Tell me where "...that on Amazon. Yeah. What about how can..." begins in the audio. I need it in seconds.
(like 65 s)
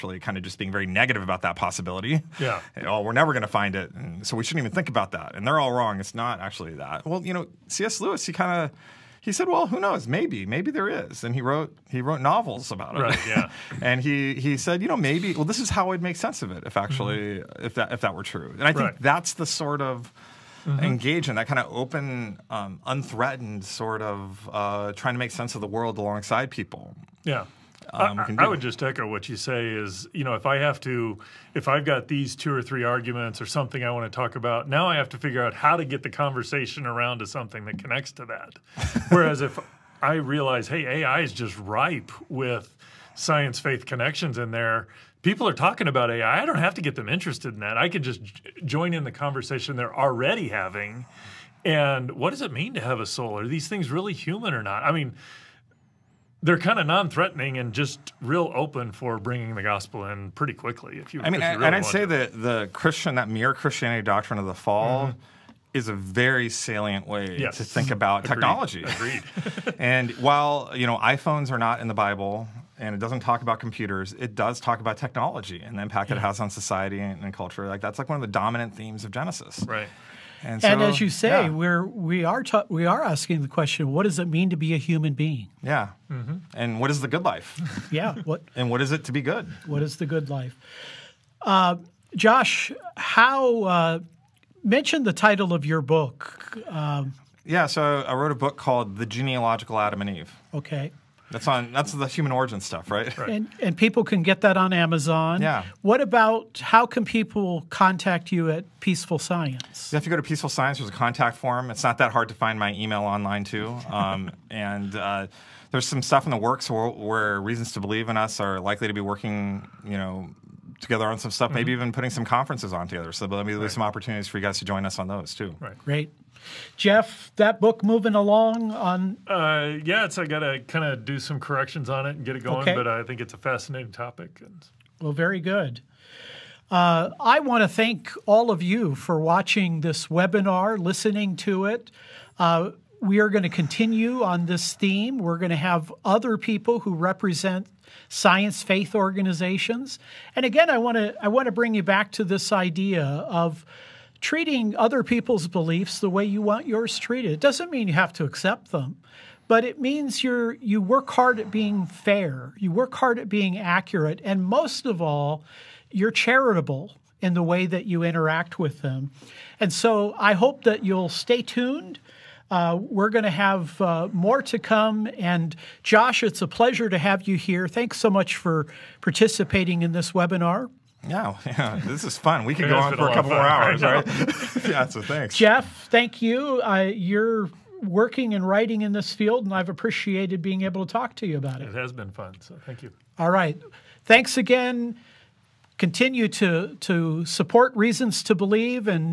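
104 s.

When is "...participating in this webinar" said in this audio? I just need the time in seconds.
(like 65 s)
178 s.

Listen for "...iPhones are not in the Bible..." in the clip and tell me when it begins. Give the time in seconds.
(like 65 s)
70 s.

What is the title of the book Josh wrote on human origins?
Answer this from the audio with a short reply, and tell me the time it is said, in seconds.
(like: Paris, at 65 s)
The Genealogical Adam and Eve, at 98 s.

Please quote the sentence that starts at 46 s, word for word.
I don't have to get them interested in that.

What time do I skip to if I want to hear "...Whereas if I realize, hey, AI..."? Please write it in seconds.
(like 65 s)
39 s.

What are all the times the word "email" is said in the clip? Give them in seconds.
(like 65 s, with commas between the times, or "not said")
112 s.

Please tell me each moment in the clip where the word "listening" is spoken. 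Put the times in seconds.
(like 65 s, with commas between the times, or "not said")
140 s.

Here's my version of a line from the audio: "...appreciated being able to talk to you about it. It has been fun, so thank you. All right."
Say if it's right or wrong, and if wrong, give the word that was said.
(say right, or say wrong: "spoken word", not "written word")
right.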